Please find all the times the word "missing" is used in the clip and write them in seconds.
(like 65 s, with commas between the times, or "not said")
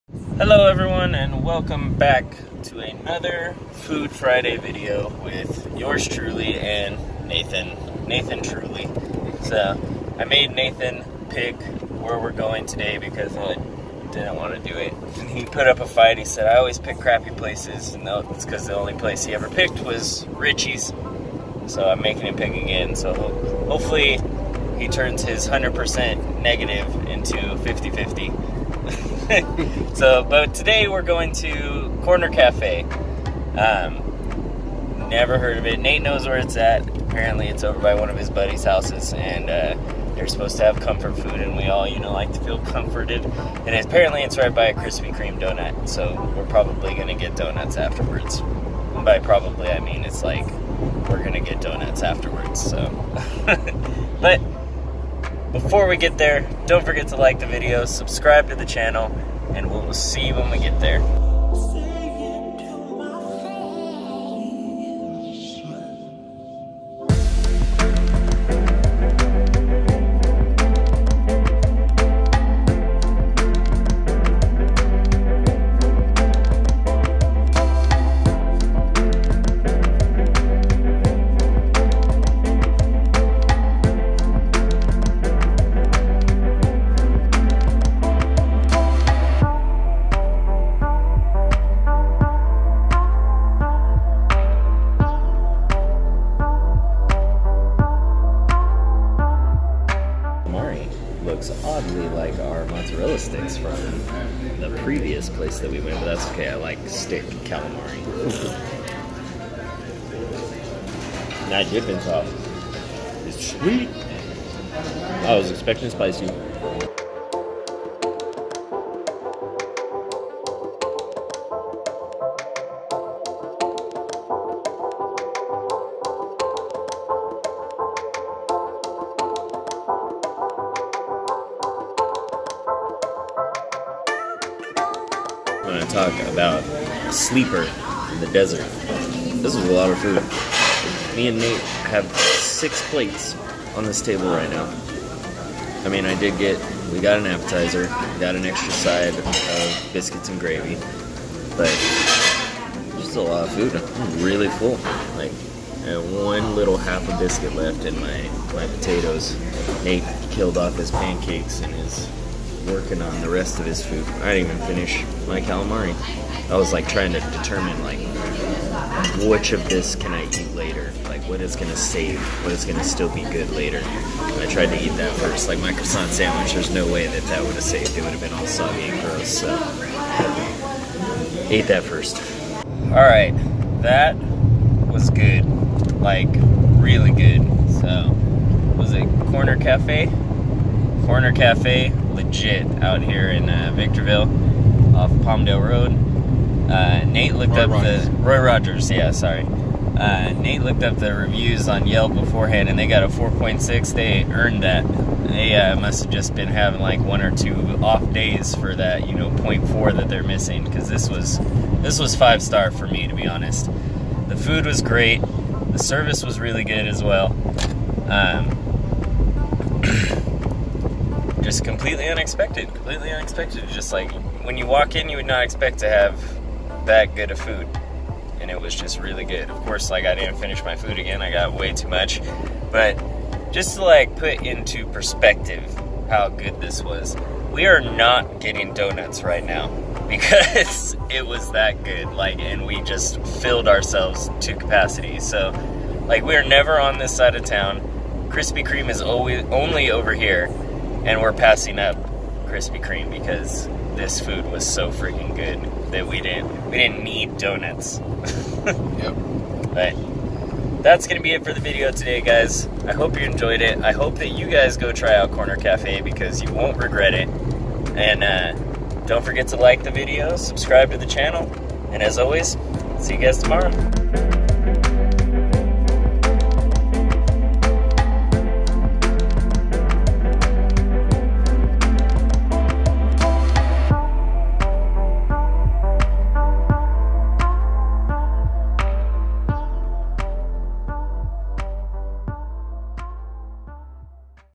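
210 s.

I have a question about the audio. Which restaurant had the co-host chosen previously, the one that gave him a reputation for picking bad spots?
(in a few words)
Richie's.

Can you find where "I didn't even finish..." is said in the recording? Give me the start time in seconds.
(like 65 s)
164 s.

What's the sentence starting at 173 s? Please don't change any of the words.
I tried to eat that first.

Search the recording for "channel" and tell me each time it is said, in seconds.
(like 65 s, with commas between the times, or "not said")
58 s, 271 s.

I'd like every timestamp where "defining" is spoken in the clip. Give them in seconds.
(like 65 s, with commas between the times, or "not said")
not said.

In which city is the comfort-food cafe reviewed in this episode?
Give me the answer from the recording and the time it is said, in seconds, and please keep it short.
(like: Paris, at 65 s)
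Victorville, at 193 s.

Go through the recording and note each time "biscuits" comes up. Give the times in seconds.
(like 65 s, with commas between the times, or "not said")
149 s, 157 s.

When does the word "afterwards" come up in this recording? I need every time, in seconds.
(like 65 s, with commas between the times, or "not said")
47 s, 52 s.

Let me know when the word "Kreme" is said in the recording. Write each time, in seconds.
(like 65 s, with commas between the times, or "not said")
45 s, 248 s, 252 s.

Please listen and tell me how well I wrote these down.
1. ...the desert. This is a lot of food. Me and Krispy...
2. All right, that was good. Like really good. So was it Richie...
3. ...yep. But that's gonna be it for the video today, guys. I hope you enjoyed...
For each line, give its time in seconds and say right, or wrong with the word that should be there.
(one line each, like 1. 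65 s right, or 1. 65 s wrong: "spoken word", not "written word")
1. 138 s wrong: "Nate", not "Krispy"
2. 182 s wrong: "Corner", not "Richie"
3. 258 s right.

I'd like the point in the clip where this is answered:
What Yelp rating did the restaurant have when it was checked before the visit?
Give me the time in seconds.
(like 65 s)
203 s.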